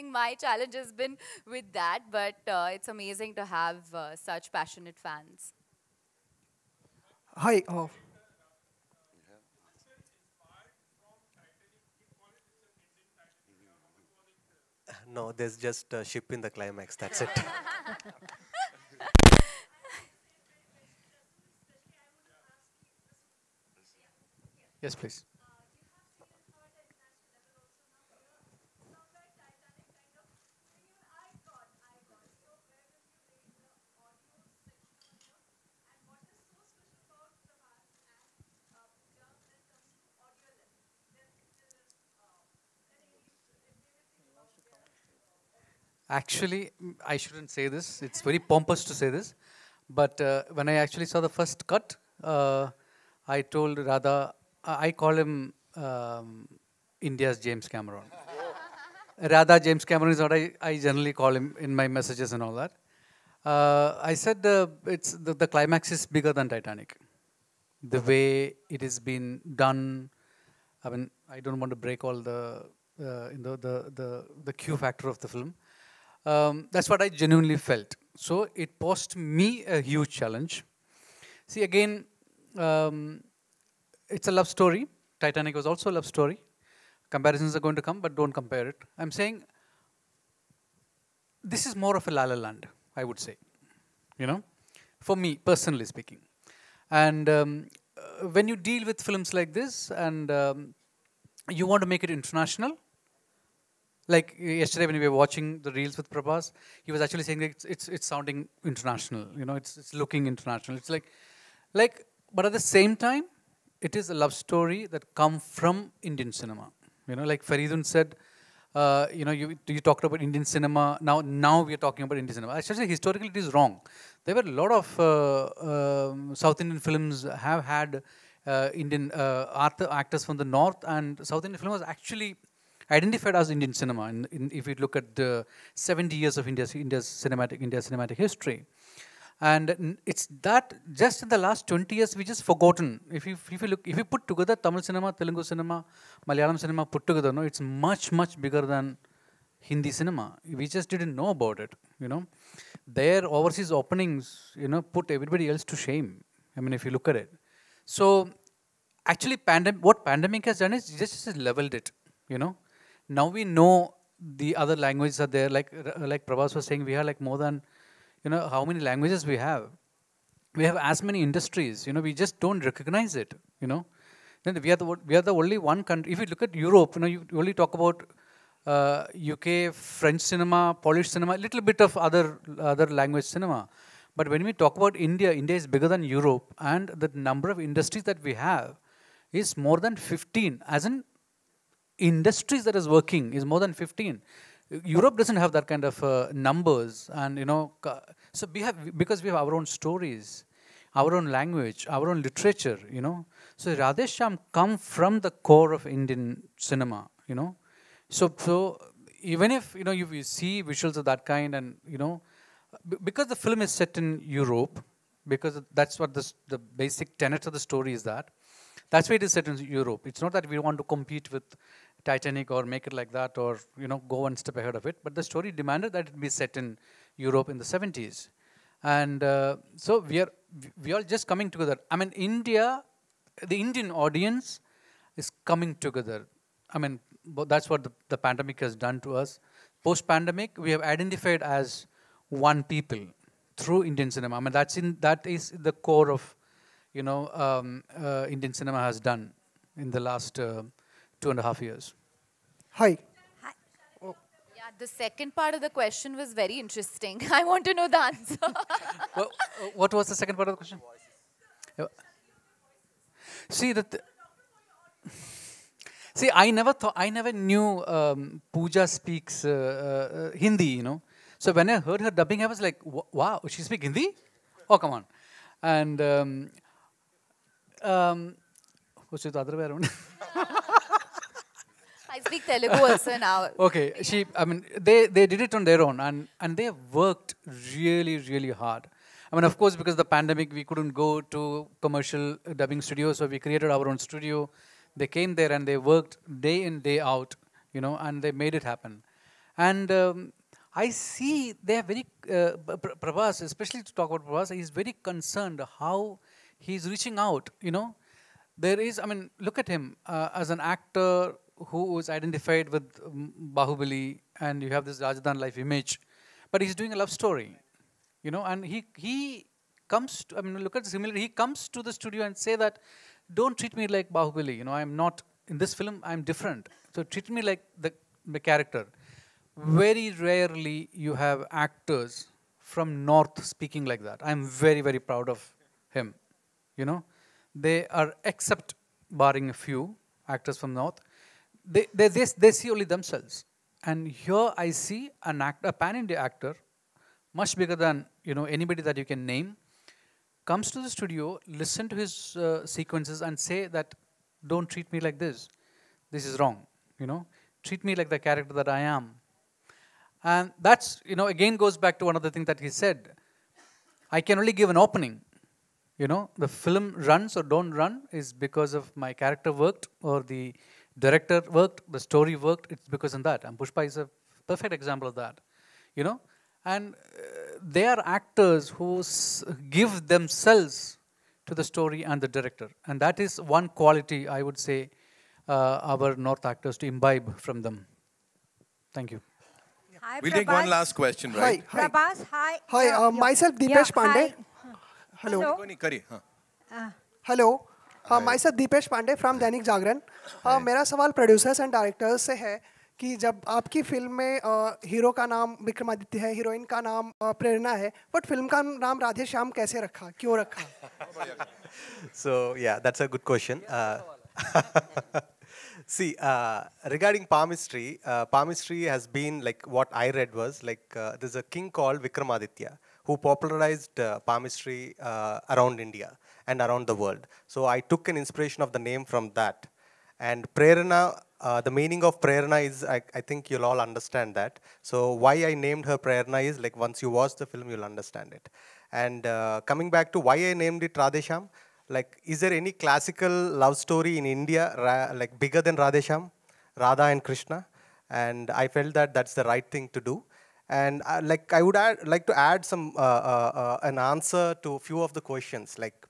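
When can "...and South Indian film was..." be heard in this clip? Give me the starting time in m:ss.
2:10.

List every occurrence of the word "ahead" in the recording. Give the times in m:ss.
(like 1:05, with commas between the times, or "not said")
3:44.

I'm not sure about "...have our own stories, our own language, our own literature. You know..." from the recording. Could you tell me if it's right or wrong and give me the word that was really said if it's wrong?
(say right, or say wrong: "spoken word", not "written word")
right.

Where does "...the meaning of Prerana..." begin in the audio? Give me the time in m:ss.
7:11.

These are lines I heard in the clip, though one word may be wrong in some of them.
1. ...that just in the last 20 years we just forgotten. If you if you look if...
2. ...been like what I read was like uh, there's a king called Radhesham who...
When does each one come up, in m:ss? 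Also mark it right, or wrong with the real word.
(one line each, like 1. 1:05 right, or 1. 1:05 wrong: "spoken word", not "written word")
1. 2:20 right
2. 6:59 wrong: "Vikramaditya", not "Radhesham".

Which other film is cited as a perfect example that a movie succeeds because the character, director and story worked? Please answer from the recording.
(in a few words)
Pushpa.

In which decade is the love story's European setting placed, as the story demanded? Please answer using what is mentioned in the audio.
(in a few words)
the 70s.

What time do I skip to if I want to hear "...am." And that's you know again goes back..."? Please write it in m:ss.
5:58.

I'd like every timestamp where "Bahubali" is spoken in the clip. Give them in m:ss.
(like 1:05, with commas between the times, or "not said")
5:13, 5:24.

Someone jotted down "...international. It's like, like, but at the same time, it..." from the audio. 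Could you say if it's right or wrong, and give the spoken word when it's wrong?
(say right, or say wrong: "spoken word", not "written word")
right.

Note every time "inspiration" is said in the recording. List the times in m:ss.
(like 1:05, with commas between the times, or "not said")
7:08.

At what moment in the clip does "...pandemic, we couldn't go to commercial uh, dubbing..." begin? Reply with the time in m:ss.
4:50.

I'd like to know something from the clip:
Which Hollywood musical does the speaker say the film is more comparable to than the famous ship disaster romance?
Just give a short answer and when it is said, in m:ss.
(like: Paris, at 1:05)
La La Land, at 1:32.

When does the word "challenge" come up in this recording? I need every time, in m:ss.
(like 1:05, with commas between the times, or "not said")
0:00, 1:20.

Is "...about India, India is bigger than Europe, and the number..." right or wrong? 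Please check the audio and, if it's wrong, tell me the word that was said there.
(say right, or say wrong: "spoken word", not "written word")
right.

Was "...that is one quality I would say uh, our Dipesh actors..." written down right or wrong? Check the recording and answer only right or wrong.
wrong.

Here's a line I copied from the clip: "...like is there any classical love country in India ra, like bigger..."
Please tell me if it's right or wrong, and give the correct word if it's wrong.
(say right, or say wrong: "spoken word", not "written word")
wrong: "story", not "country".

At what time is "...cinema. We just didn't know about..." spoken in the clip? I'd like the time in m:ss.
2:29.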